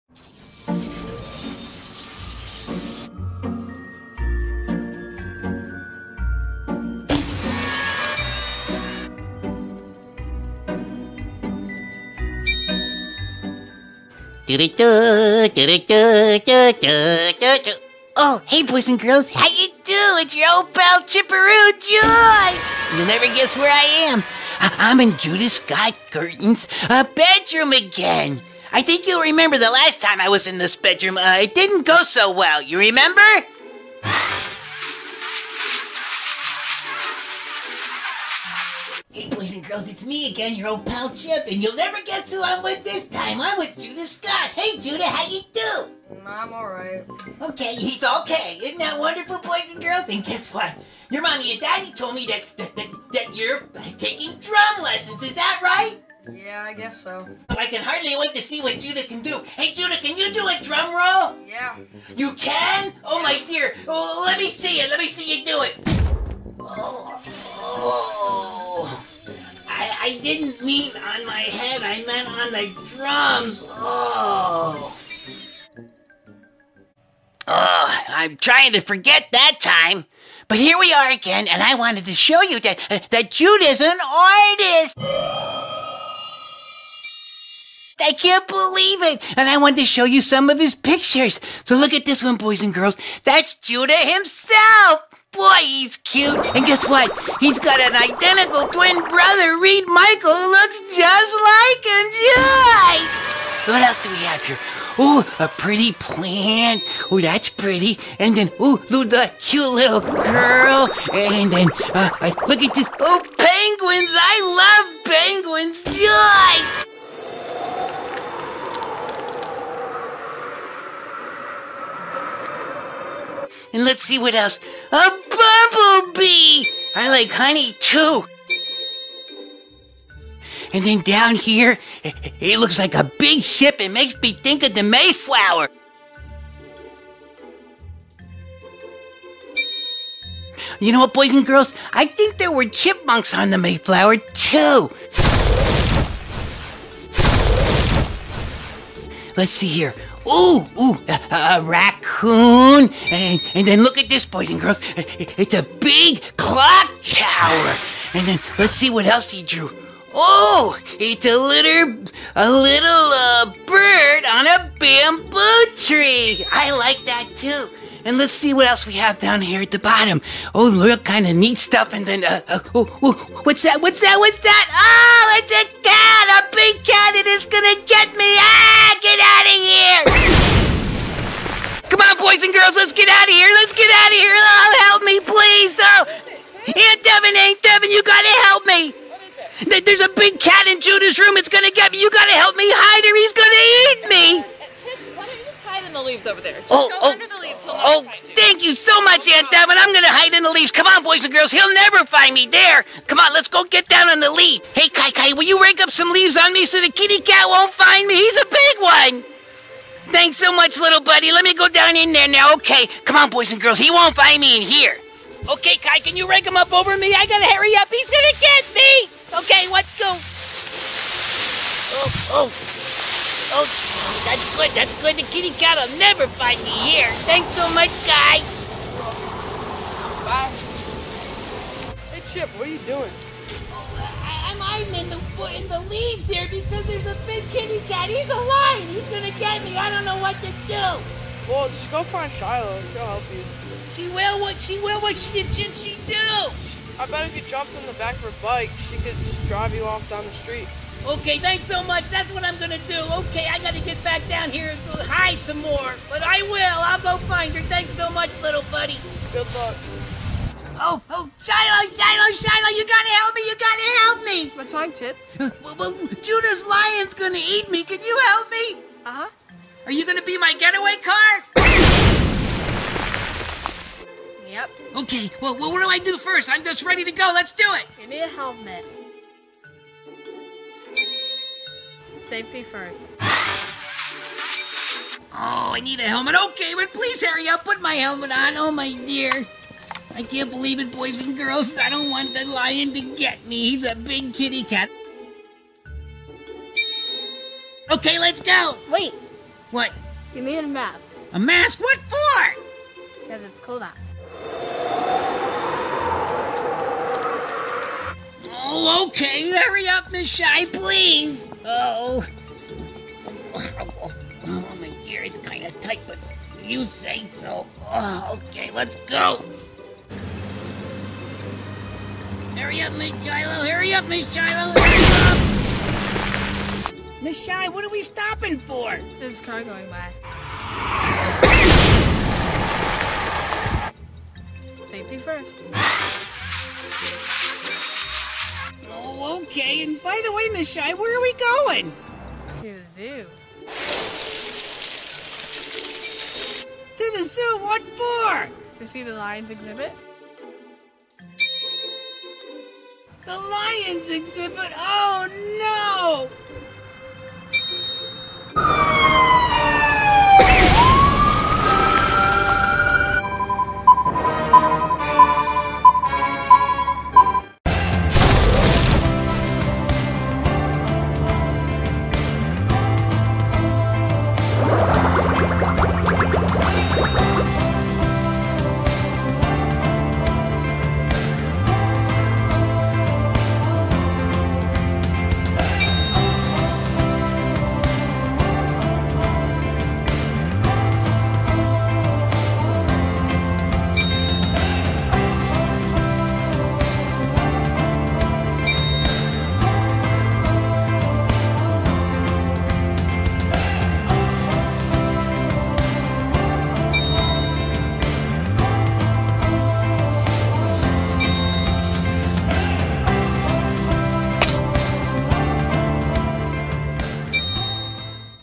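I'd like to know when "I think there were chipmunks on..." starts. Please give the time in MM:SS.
02:21.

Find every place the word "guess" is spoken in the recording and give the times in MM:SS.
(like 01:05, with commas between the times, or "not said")
00:23, 00:42, 00:50, 00:56, 01:36.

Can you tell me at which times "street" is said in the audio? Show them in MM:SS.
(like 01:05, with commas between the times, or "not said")
04:10.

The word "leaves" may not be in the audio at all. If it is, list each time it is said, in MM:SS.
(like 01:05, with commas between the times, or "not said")
03:16, 03:20, 03:26, 03:55.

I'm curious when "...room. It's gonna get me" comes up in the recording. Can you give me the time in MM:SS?
03:11.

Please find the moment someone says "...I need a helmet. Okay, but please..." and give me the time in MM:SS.
04:45.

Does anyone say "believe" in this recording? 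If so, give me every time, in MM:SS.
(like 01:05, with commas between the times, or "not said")
01:28, 04:50.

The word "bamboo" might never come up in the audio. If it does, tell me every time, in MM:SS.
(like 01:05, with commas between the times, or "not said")
02:44.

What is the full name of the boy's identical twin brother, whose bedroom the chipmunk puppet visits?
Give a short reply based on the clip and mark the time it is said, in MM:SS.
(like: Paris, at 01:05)
Reed Michael, at 01:39.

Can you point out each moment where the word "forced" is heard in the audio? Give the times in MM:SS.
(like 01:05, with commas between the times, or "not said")
not said.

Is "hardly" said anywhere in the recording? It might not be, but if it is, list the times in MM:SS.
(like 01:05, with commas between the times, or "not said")
00:57.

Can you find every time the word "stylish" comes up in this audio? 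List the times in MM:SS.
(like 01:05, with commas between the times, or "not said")
not said.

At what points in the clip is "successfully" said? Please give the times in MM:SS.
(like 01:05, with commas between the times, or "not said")
not said.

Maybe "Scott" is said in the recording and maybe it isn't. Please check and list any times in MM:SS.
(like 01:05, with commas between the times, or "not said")
00:25, 00:44.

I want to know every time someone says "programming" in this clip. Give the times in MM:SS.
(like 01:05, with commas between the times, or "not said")
not said.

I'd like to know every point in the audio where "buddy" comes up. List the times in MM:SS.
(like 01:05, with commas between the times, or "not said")
03:31, 04:18.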